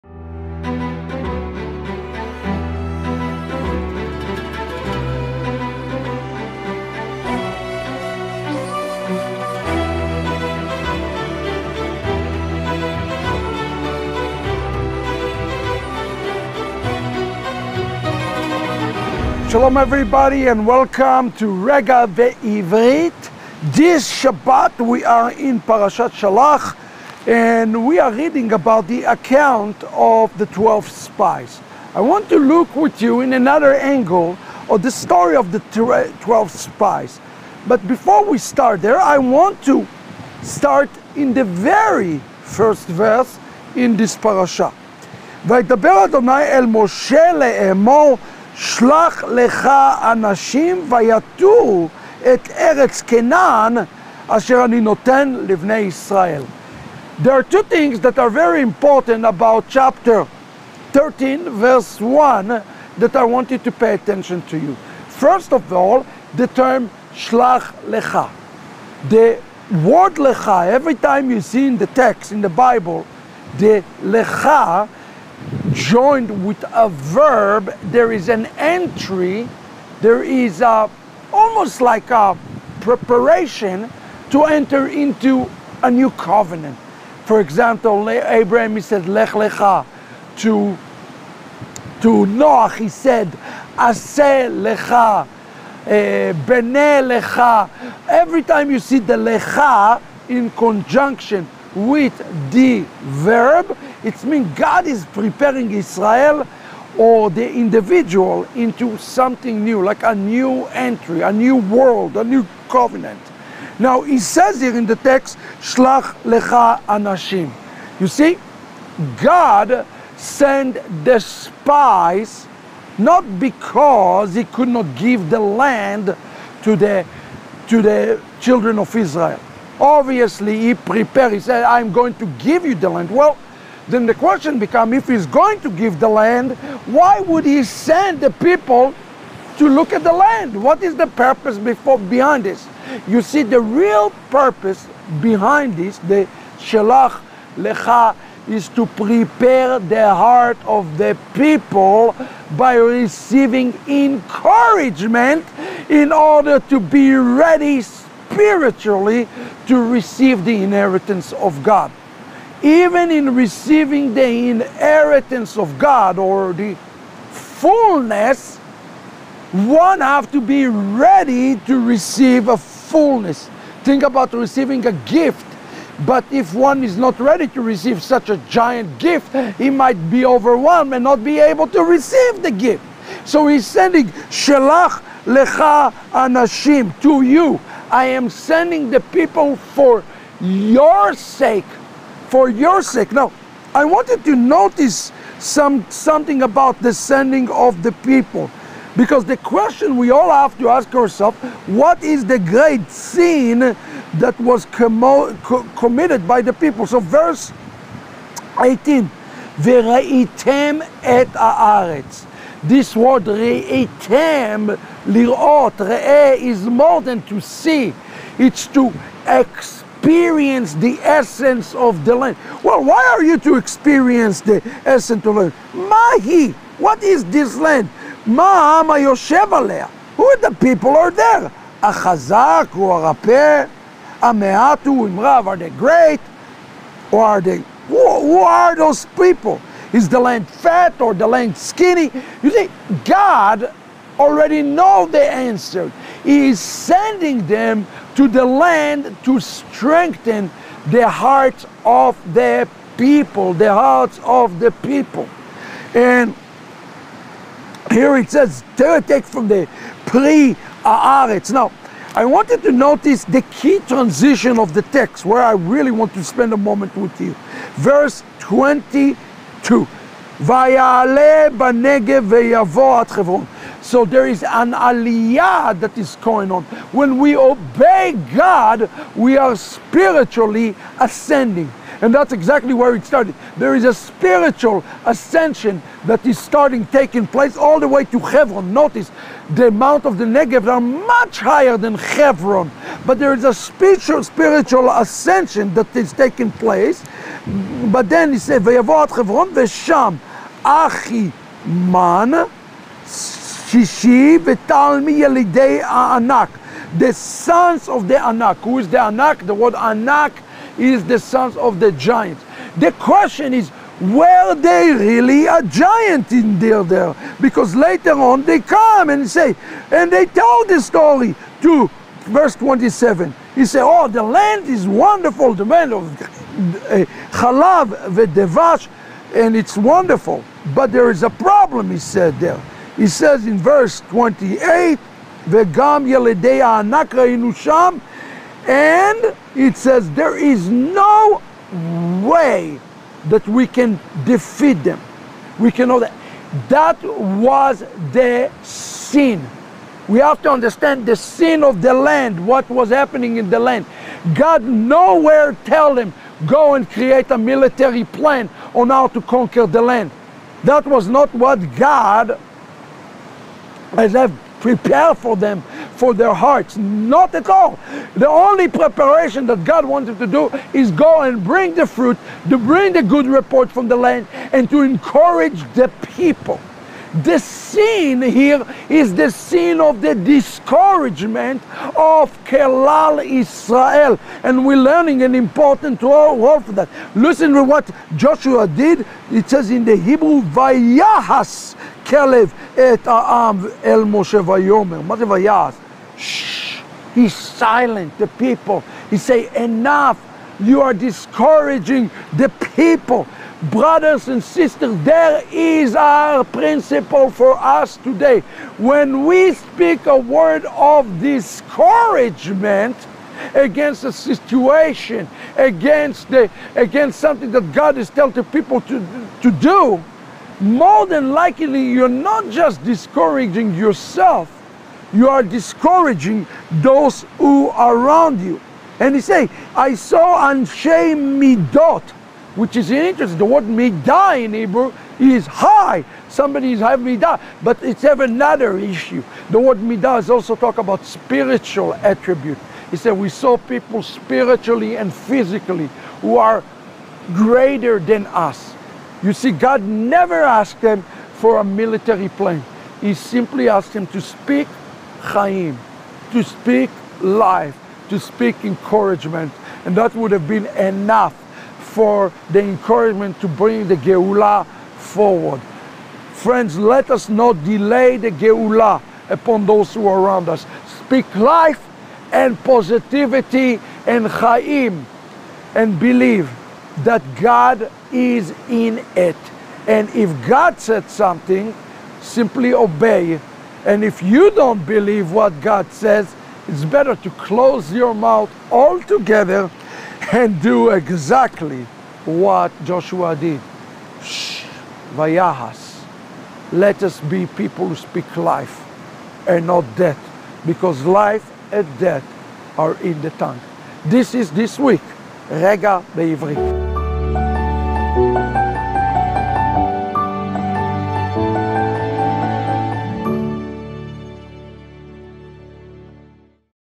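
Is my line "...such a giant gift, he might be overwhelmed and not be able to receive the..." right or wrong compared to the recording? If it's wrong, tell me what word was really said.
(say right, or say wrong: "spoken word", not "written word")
right.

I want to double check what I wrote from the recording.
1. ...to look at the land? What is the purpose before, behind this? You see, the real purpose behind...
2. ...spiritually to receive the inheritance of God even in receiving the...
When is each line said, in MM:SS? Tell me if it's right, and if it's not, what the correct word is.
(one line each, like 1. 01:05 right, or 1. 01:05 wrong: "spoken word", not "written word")
1. 02:19 right
2. 02:37 right.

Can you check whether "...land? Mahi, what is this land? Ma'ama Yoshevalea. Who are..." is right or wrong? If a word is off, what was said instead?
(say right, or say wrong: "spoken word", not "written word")
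right.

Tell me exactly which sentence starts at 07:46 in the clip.
Friends, let us not delay the Geulah upon those who are around us.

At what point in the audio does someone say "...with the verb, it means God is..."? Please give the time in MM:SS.
01:41.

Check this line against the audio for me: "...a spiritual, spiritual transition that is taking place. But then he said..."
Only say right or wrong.
wrong.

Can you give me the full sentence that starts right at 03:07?
I am sending the people for your sake for your sake.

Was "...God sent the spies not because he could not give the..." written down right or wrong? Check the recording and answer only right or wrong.
right.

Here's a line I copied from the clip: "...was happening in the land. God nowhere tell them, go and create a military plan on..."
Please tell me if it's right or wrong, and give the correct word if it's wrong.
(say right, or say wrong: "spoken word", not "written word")
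right.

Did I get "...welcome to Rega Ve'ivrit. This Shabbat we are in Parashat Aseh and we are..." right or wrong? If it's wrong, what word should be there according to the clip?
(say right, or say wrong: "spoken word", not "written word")
wrong: "Shelach", not "Aseh".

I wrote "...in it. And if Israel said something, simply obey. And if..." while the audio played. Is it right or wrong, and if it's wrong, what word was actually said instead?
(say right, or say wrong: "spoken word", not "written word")
wrong: "God", not "Israel".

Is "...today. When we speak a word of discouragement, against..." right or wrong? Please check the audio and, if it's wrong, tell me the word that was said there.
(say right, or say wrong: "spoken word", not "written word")
right.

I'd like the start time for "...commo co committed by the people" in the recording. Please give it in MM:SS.
03:24.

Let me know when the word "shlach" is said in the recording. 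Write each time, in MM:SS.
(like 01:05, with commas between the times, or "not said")
01:07, 01:55.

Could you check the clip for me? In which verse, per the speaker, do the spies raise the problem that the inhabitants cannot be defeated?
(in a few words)
28.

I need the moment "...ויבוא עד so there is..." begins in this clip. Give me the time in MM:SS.
04:32.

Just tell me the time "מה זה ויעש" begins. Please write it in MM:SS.
06:35.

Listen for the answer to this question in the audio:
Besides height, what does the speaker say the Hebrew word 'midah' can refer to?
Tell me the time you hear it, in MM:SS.
07:21.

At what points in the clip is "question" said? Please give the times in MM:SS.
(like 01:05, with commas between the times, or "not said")
02:14, 03:19, 05:12.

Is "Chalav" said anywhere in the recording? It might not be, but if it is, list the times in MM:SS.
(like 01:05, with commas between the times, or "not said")
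05:27.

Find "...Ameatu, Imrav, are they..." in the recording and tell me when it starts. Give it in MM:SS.
03:54.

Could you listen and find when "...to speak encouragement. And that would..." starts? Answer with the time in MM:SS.
07:38.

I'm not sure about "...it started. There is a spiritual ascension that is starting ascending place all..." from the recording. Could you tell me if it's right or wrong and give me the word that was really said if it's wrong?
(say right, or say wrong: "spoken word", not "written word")
wrong: "taking", not "ascending".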